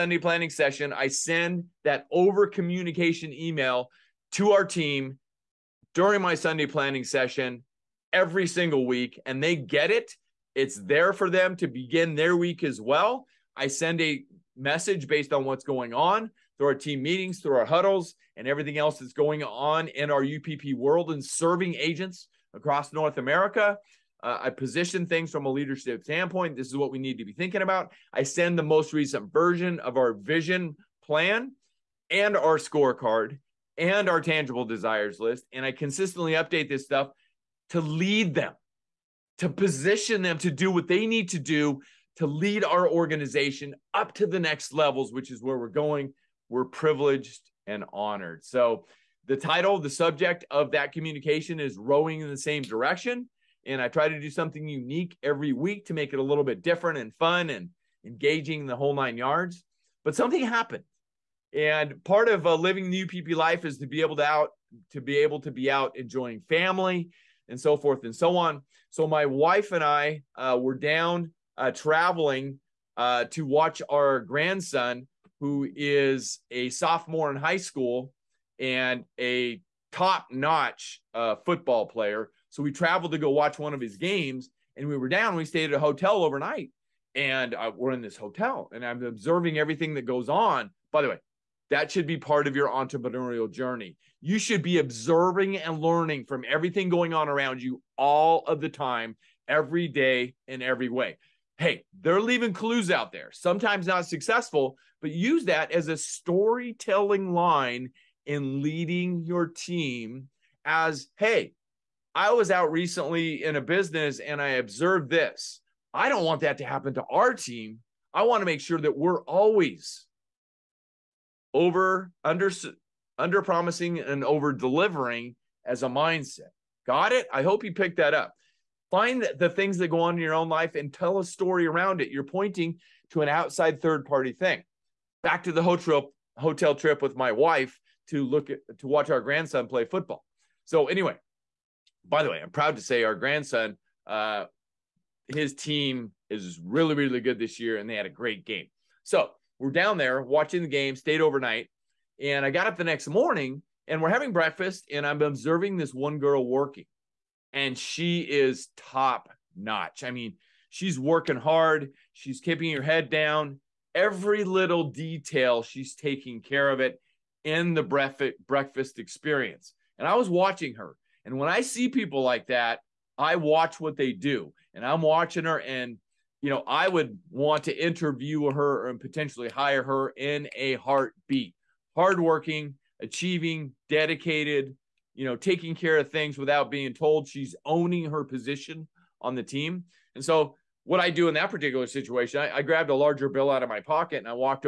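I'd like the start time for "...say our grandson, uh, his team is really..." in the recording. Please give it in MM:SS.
02:22.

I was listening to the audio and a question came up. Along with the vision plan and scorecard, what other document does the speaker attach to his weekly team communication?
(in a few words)
tangible desires list.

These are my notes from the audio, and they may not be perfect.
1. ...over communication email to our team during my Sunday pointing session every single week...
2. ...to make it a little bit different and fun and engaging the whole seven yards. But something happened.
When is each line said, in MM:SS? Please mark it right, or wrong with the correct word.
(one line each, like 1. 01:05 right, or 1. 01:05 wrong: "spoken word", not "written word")
1. 00:02 wrong: "planning", not "pointing"
2. 00:55 wrong: "nine", not "seven".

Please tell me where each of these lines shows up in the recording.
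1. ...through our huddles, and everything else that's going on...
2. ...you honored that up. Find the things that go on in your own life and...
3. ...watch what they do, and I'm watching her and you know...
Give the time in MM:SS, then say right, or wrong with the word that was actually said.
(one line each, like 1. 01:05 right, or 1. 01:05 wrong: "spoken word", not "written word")
1. 00:17 right
2. 02:07 wrong: "picked", not "honored"
3. 02:53 right.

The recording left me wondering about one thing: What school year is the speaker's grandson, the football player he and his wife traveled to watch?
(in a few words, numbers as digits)
sophomore.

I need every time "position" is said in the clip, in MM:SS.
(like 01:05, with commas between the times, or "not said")
00:24, 00:39, 03:08.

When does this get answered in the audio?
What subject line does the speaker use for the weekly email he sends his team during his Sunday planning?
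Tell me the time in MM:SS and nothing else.
00:51.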